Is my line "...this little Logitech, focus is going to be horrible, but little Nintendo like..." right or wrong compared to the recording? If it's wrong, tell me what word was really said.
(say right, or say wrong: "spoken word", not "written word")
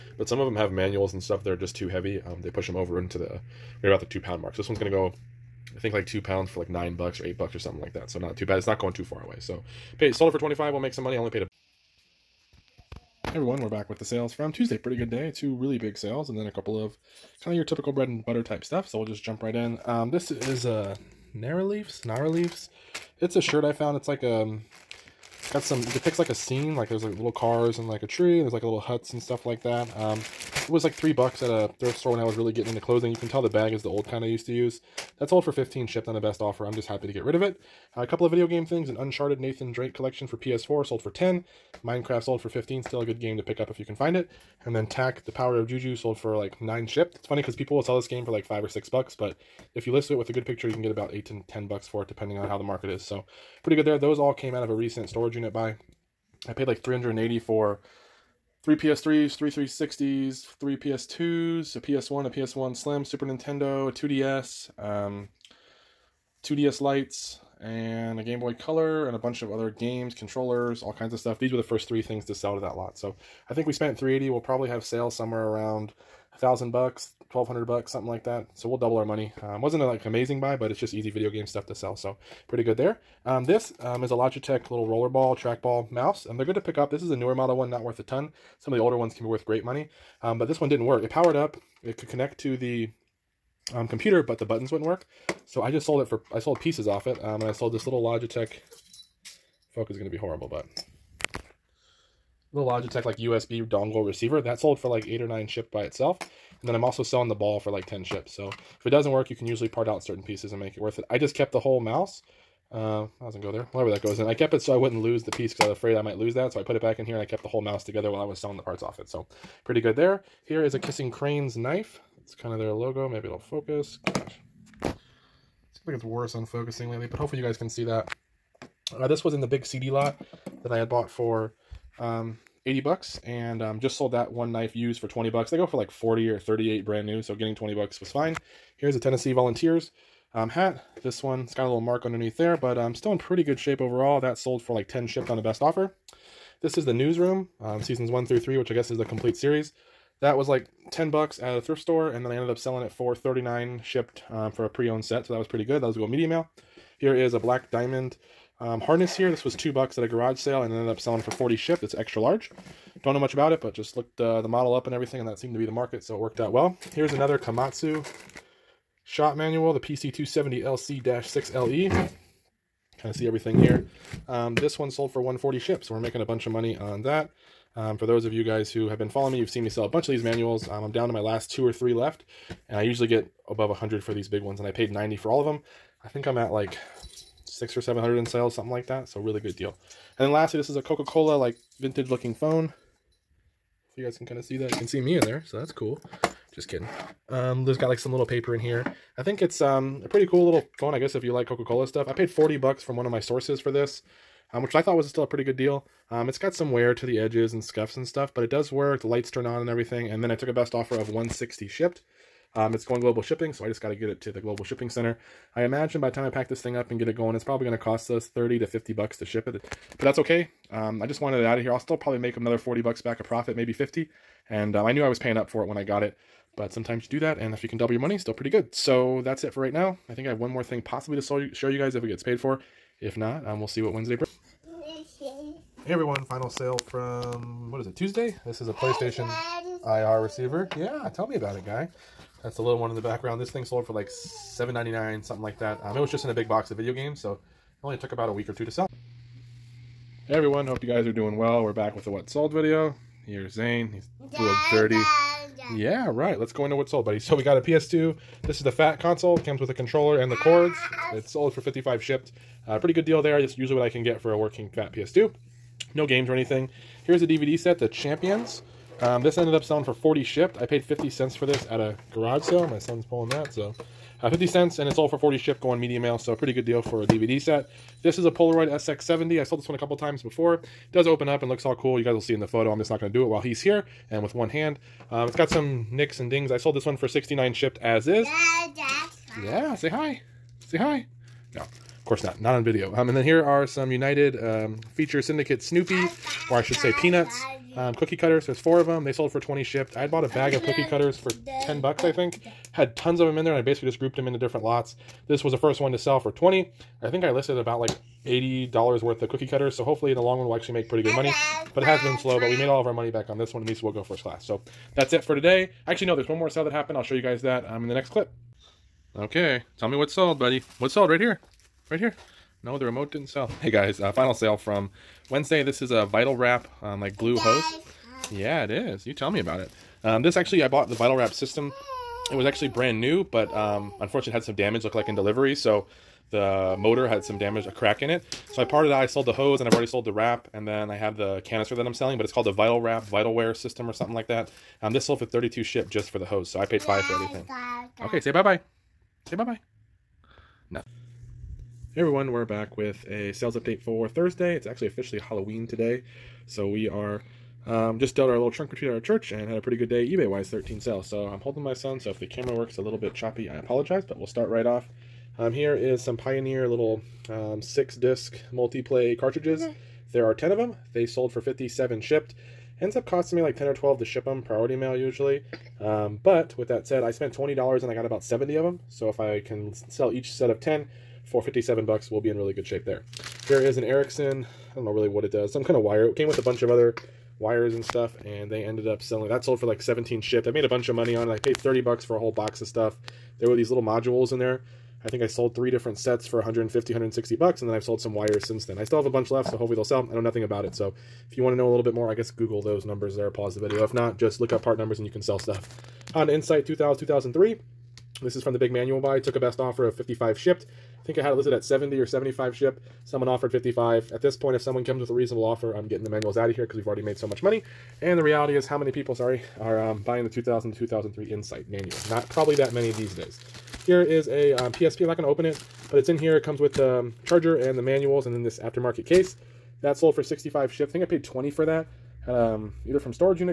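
wrong: "Logitech", not "Nintendo".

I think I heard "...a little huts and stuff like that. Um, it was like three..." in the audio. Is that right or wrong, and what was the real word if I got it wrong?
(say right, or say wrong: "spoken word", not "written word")
right.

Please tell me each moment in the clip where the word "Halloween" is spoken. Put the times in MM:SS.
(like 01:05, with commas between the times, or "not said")
05:55.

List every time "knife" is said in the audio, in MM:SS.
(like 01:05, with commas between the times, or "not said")
02:01, 02:14.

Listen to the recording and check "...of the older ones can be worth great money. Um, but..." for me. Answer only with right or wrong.
right.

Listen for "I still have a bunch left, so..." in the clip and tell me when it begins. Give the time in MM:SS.
06:38.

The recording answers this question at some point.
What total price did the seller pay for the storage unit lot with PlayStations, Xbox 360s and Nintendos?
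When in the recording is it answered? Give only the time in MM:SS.
00:56.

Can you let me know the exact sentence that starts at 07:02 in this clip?
Not probably that many these days.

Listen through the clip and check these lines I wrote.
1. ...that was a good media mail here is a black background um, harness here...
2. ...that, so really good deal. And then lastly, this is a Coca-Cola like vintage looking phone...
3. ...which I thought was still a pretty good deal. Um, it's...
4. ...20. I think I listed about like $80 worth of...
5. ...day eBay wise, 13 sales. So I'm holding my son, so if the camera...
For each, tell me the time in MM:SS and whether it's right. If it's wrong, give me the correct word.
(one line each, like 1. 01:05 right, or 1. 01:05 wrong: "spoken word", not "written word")
1. 02:35 wrong: "diamond", not "background"
2. 03:08 right
3. 03:24 right
4. 05:06 right
5. 05:59 right.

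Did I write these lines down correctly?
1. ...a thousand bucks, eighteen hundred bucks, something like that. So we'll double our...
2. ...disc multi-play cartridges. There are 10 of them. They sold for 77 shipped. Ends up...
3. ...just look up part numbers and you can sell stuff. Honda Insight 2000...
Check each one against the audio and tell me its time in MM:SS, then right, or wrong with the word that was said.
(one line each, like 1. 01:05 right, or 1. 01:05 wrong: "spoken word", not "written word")
1. 01:16 wrong: "twelve", not "eighteen"
2. 06:07 wrong: "57", not "77"
3. 06:44 right.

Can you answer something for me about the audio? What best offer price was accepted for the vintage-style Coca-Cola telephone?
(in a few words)
160.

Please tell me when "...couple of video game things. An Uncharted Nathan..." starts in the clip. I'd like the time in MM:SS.
00:38.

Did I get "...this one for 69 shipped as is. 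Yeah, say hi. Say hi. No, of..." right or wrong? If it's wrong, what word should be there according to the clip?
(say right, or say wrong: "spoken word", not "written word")
right.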